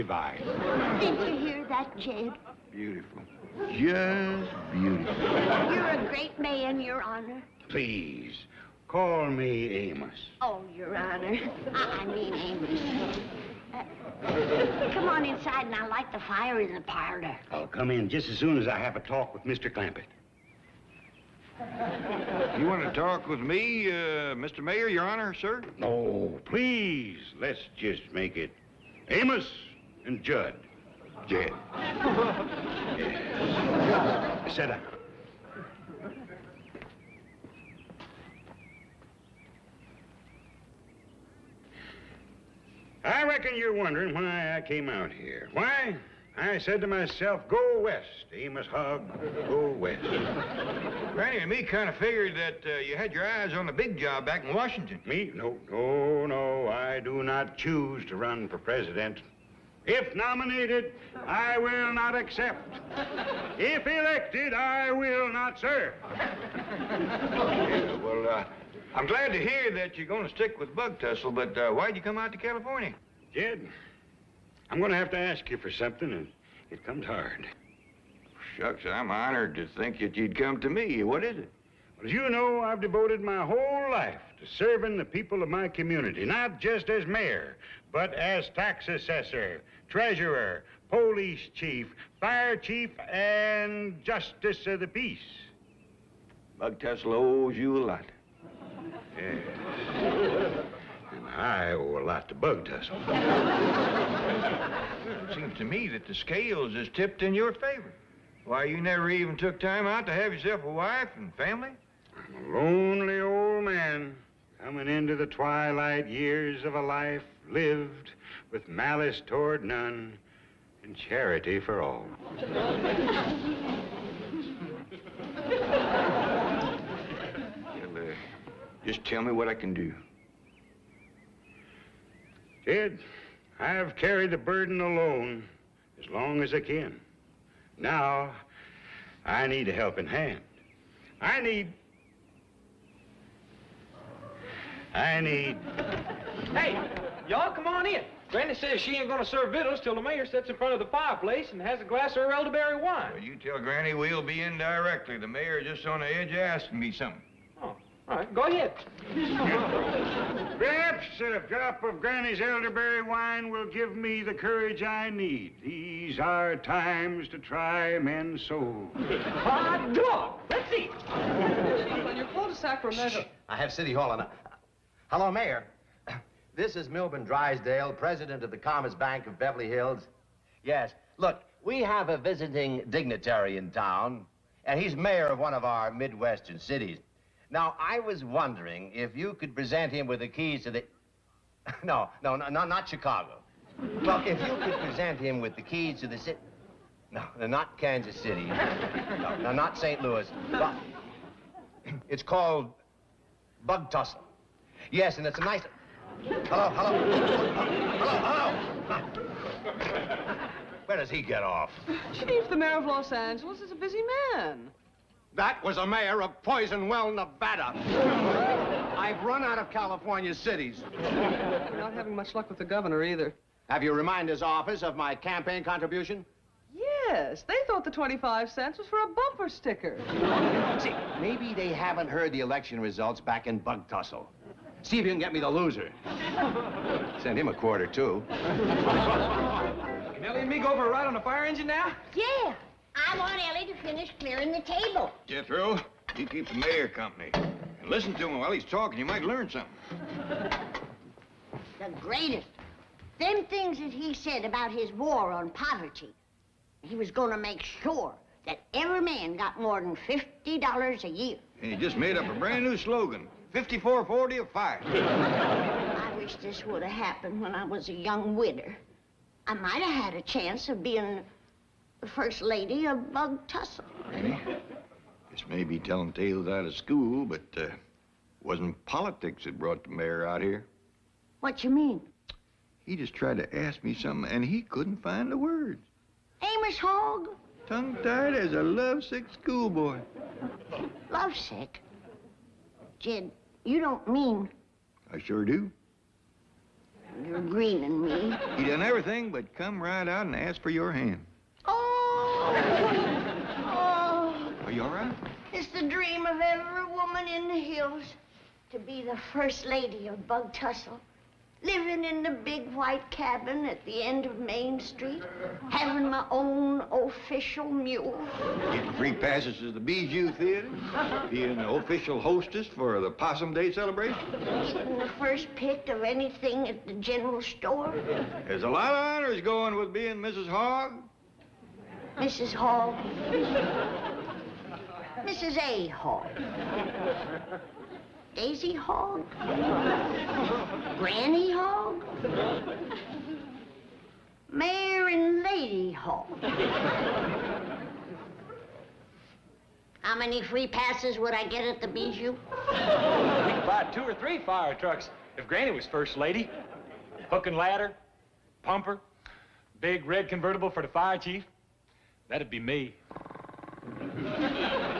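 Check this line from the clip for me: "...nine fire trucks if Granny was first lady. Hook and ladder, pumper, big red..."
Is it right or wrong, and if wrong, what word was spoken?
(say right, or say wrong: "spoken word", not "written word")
wrong: "three", not "nine".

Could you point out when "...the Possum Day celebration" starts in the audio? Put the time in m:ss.
5:22.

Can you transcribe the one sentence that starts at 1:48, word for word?
Why, you never even took time out to have yourself a wife and family?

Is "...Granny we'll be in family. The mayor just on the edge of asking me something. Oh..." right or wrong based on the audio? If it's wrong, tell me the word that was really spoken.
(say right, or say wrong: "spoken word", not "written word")
wrong: "directly", not "family".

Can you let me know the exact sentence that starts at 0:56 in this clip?
I do not choose to run for president.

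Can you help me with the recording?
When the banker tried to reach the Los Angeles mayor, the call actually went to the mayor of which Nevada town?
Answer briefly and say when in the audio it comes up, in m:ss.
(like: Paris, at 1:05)
Poison Well, at 3:36.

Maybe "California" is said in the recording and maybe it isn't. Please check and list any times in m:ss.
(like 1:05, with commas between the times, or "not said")
1:12, 3:39.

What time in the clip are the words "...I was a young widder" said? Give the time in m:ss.
4:27.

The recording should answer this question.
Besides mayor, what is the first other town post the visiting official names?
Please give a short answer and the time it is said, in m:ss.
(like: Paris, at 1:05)
Tax assessor, at 1:28.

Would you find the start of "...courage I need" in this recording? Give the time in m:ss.
2:44.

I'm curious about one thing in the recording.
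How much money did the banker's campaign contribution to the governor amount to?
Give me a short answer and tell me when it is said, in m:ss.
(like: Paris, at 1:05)
25 cents, at 3:47.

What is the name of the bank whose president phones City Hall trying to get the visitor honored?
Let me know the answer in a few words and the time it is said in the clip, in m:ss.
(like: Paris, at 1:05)
Commerce Bank of Beverly Hills, at 2:58.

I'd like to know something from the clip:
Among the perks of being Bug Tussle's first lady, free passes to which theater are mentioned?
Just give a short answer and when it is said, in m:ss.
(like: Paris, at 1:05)
Bijou Theater, at 5:19.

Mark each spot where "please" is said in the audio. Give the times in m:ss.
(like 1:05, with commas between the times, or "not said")
0:07, 0:26.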